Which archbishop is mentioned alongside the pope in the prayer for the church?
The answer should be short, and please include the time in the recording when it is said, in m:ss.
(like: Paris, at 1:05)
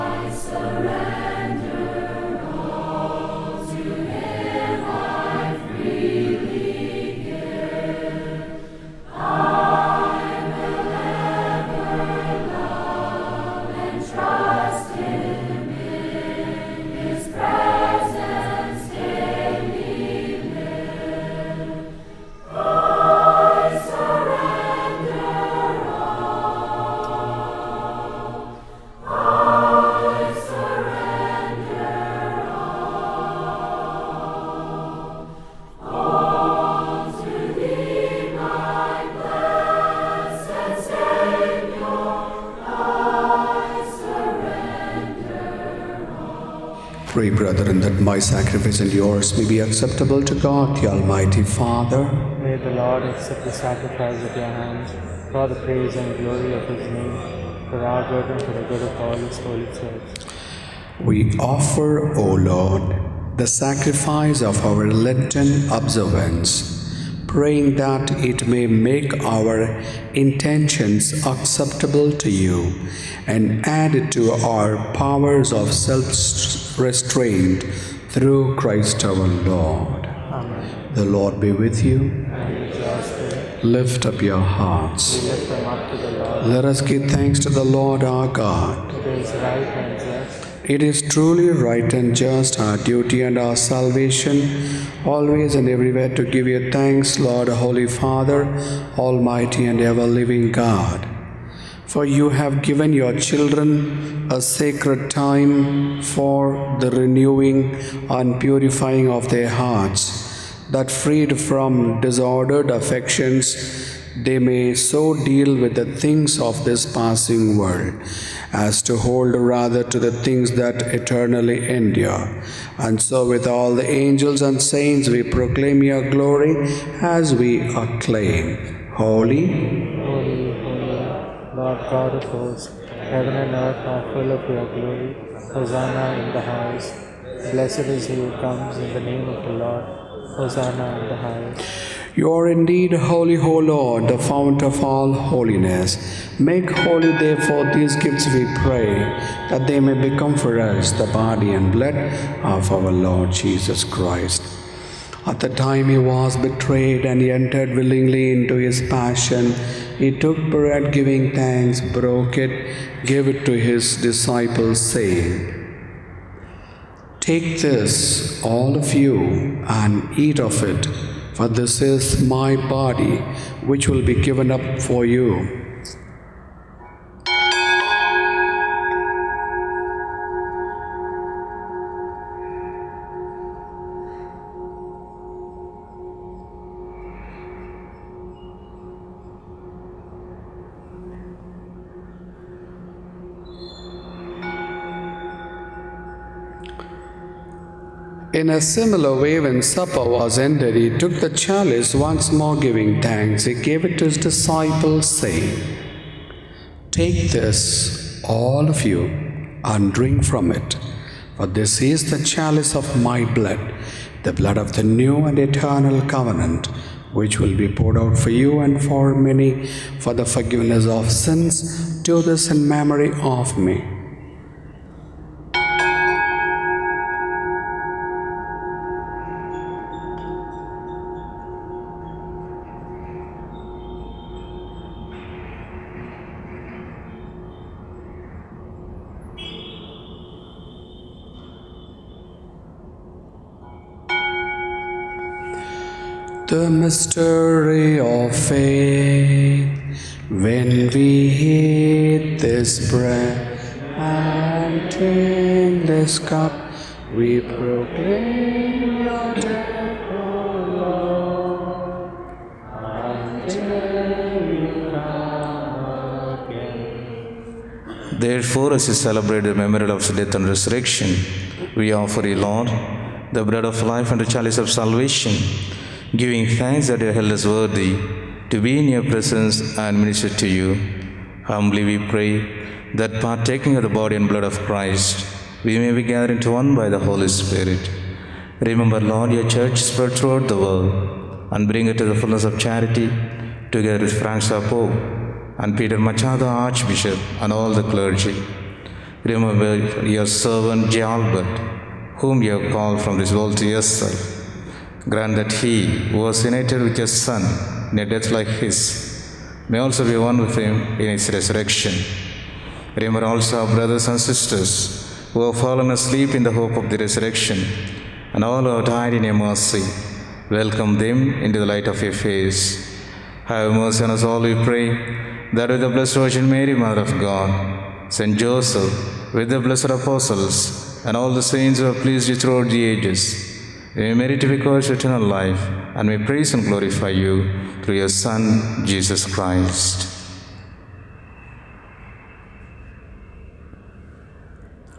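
Peter Machado, at 4:55.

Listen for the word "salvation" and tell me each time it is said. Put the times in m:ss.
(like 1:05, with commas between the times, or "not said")
1:33, 4:34.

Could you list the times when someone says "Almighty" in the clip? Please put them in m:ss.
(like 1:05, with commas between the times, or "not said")
0:50, 1:38.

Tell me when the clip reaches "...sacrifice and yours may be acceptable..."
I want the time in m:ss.
0:48.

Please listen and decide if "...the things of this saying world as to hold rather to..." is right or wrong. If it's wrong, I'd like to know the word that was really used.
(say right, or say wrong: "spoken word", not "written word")
wrong: "passing", not "saying".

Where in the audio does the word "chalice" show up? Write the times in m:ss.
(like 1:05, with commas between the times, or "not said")
3:21, 3:32, 4:34.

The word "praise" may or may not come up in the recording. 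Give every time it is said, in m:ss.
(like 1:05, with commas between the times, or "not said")
0:55, 5:36.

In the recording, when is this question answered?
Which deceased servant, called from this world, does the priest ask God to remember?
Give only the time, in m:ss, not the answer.
5:00.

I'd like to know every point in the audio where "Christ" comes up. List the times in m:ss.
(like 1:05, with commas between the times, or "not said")
1:18, 2:33, 4:44, 5:39.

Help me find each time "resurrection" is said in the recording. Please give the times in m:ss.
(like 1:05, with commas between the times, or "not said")
4:30, 5:11, 5:16.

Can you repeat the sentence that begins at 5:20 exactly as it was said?
Welcome them into the light of your face.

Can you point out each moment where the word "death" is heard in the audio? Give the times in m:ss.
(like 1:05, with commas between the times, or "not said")
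4:19, 4:30, 5:08.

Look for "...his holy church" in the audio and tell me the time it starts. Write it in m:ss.
0:59.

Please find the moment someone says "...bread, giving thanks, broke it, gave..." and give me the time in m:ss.
2:40.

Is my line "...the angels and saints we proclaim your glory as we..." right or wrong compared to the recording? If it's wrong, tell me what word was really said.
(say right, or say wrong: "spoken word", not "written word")
right.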